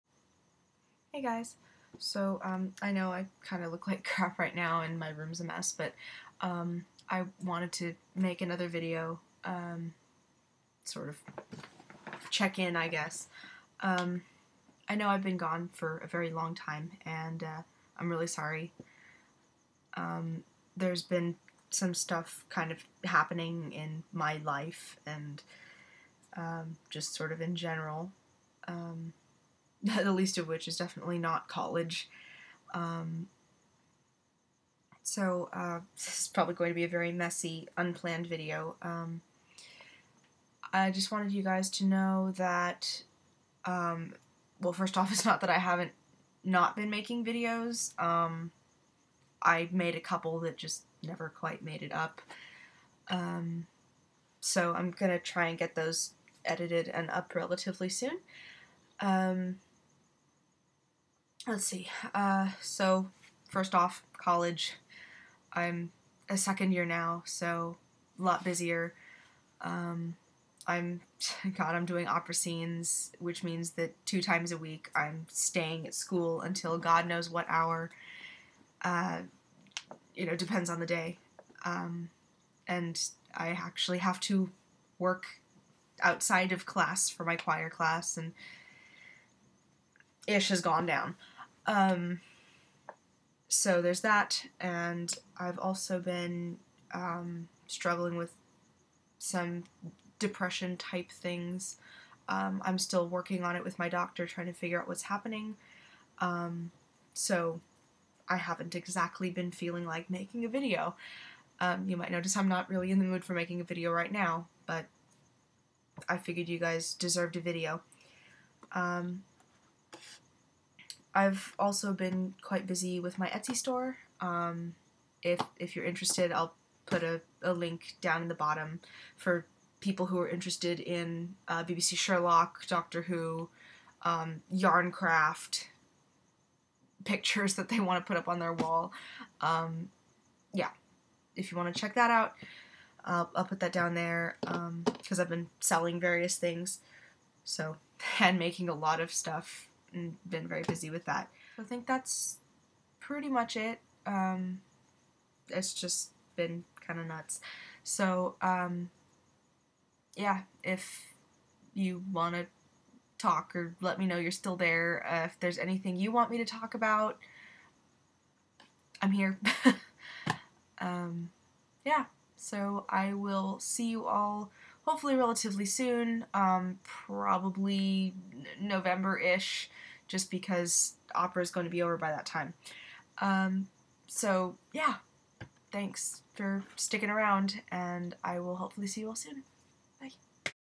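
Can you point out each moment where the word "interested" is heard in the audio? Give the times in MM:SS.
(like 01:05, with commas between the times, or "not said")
02:05, 02:10.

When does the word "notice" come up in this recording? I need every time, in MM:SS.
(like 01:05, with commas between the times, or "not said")
01:52.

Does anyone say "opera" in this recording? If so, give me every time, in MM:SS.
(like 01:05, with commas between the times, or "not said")
01:12, 03:01.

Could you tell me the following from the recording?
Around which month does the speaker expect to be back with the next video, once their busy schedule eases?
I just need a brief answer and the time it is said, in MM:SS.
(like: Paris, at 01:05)
November, at 02:58.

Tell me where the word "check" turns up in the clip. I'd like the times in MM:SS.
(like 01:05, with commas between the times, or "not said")
00:12, 02:21.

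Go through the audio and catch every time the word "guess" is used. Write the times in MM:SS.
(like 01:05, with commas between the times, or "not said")
00:12.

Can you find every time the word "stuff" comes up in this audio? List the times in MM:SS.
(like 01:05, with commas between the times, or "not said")
00:21, 02:29.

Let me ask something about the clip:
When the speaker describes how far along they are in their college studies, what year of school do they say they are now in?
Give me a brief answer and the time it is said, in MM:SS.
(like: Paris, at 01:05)
Second year, at 01:06.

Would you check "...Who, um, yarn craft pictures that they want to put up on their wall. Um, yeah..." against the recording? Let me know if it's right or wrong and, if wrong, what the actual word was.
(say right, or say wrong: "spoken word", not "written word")
right.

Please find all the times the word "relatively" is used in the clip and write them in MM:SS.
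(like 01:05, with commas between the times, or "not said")
00:57, 02:55.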